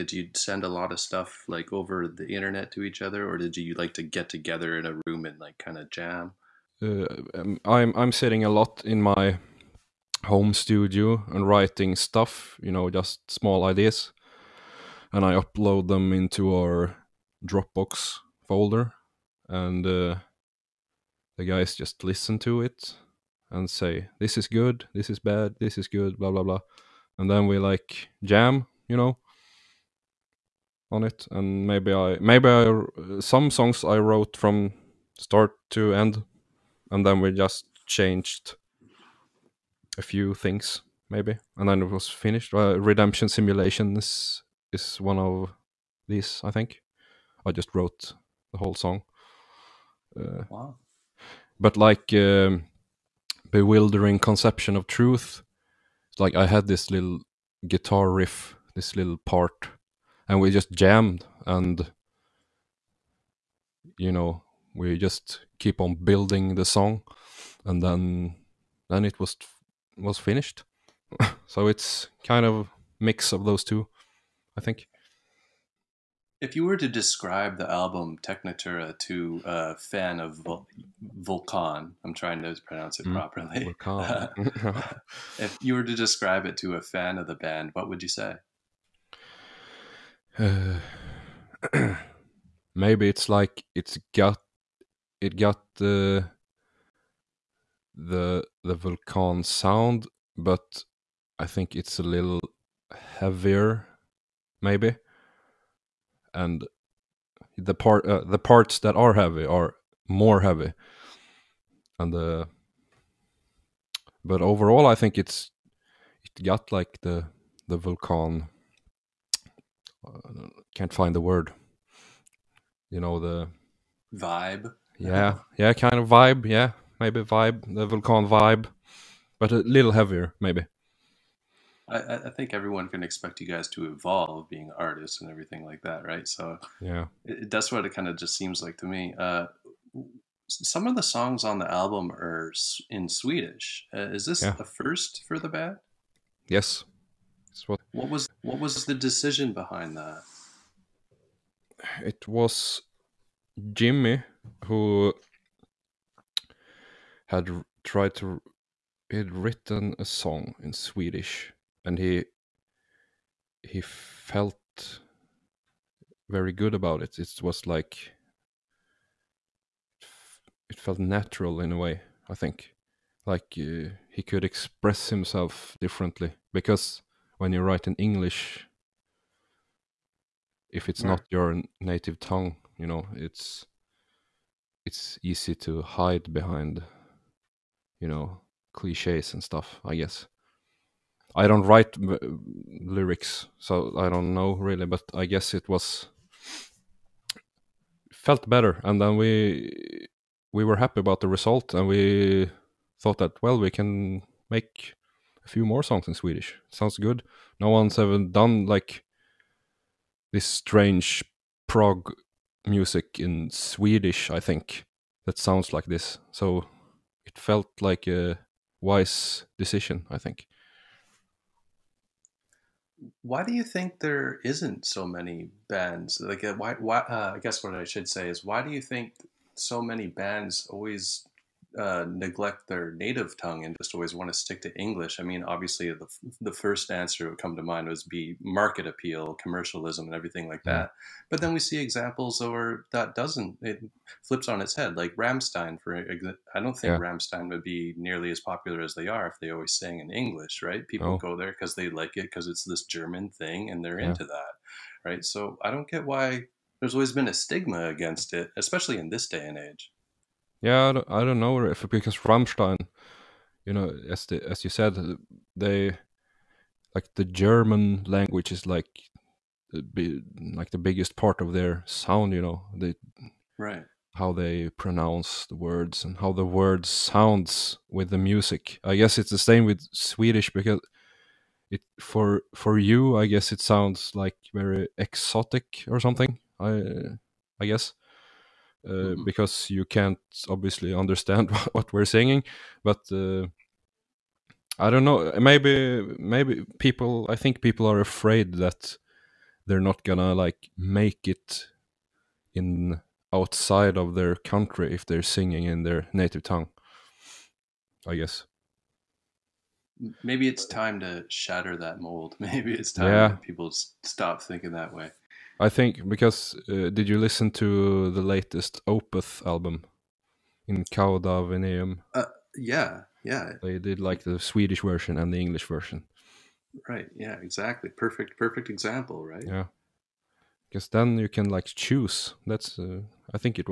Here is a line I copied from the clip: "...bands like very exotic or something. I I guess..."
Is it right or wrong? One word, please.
wrong.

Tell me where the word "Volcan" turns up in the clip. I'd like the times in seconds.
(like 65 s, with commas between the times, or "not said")
81 s, 98 s.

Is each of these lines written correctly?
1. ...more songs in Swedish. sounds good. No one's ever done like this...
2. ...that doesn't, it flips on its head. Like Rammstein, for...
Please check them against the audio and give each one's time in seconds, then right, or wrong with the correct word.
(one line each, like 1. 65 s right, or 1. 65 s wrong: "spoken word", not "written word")
1. 205 s right
2. 242 s right.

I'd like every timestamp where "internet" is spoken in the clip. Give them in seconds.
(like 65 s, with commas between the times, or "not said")
2 s.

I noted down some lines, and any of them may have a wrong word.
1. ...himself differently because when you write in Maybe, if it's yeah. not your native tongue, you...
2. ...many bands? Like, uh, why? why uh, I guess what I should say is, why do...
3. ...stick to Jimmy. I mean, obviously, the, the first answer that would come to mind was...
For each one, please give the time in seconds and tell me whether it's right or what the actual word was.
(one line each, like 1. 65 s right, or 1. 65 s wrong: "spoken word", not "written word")
1. 175 s wrong: "English", not "Maybe"
2. 225 s right
3. 234 s wrong: "English", not "Jimmy".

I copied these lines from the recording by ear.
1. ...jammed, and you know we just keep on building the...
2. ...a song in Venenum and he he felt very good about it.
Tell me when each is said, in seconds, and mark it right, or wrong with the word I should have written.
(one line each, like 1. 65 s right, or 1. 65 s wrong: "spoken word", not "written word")
1. 60 s right
2. 159 s wrong: "Swedish", not "Venenum".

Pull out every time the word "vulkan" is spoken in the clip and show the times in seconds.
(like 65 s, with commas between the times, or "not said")
117 s, 127 s.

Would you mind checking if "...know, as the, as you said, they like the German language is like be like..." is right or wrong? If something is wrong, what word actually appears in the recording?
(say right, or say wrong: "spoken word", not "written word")
right.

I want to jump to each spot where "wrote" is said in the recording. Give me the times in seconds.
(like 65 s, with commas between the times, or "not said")
33 s, 47 s.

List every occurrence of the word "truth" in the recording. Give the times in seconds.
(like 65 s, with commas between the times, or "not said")
54 s.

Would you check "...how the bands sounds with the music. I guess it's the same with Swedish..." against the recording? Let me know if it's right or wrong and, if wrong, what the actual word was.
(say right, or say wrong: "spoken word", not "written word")
wrong: "words", not "bands".